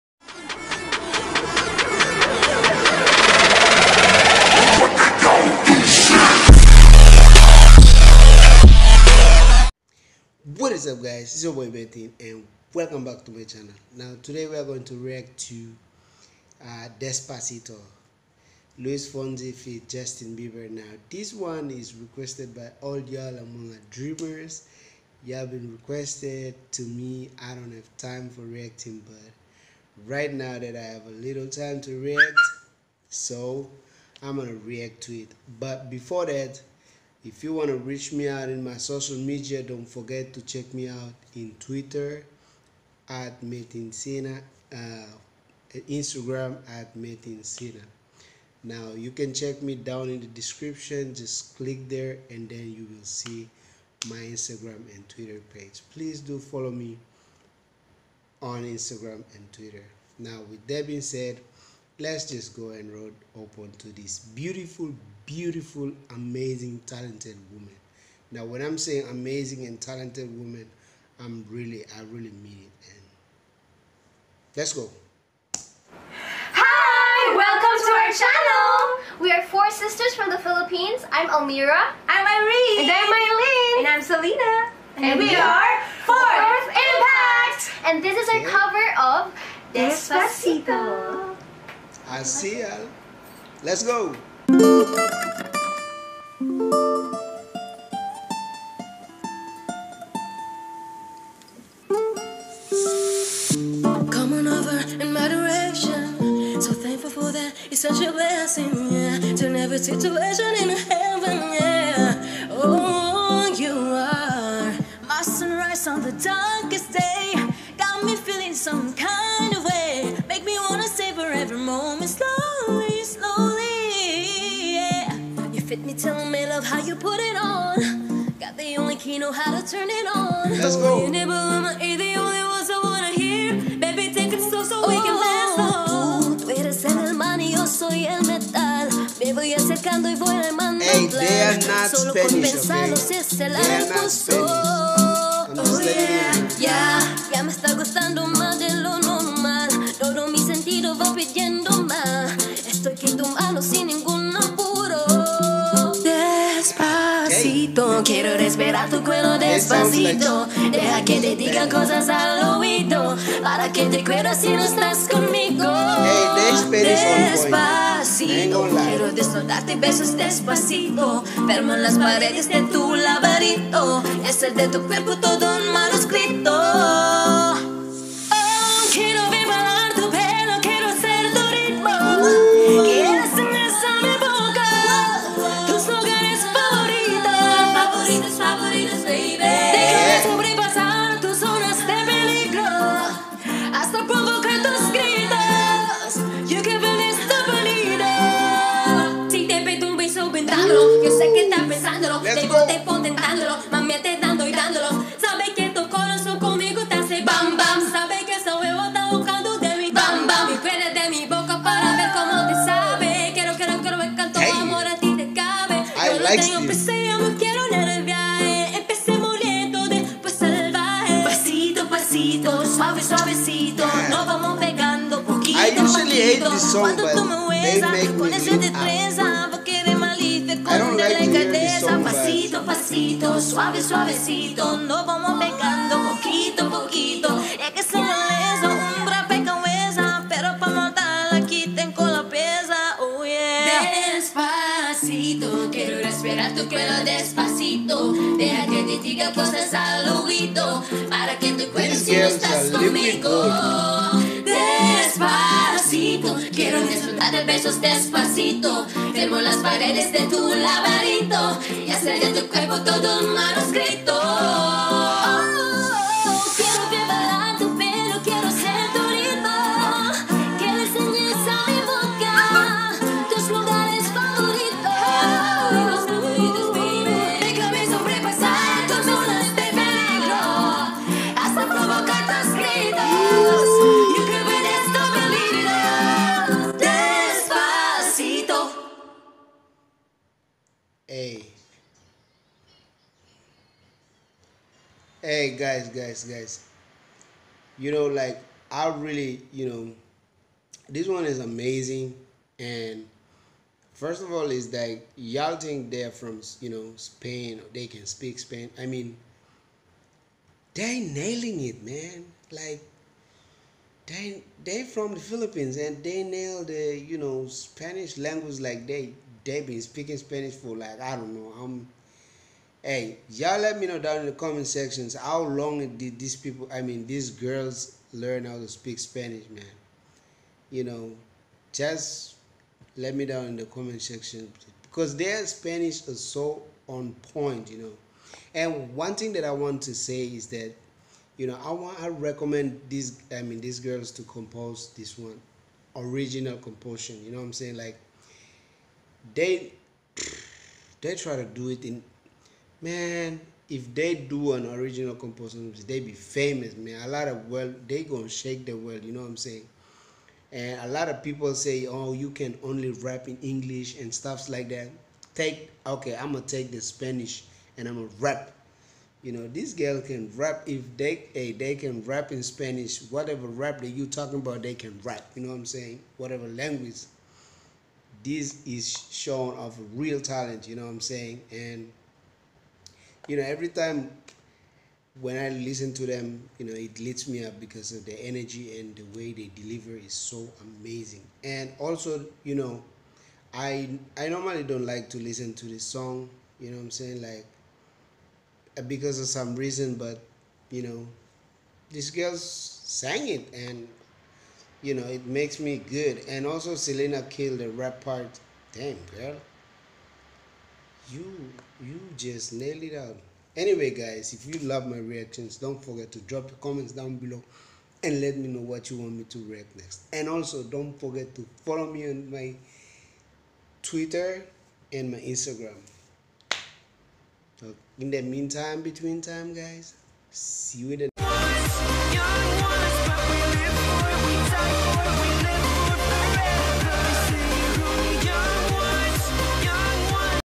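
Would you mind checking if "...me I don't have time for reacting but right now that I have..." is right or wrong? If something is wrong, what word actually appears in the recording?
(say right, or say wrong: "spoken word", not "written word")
right.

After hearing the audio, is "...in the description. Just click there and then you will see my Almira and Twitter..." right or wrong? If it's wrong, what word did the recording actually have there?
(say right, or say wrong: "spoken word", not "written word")
wrong: "Instagram", not "Almira".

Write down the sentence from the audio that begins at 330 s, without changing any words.
You know, just let me down in the comment section because their Spanish is so on point, you know.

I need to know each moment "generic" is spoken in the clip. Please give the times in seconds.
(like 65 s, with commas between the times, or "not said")
not said.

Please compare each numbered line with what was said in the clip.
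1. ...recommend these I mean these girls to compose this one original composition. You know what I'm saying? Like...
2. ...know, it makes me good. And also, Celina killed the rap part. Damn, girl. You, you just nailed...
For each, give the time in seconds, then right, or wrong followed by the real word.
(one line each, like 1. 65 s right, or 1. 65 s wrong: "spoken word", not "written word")
1. 342 s right
2. 404 s right.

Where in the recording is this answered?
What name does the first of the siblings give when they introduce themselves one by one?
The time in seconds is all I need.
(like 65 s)
81 s.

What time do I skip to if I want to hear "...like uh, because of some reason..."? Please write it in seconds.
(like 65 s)
397 s.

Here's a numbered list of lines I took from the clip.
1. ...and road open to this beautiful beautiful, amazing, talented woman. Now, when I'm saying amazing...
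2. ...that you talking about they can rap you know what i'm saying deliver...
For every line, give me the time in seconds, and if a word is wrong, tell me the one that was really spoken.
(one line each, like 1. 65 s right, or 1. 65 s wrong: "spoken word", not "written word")
1. 62 s right
2. 373 s wrong: "whatever", not "deliver".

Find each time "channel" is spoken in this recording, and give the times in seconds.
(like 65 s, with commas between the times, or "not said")
13 s, 79 s.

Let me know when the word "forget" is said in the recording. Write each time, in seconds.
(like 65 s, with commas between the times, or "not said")
39 s, 415 s, 420 s.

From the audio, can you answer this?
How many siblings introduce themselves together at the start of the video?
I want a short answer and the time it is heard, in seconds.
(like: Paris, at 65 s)
4, at 79 s.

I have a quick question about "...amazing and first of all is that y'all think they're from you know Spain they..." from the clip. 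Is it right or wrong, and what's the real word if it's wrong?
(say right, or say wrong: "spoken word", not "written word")
right.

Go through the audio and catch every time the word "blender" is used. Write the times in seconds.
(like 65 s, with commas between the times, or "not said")
not said.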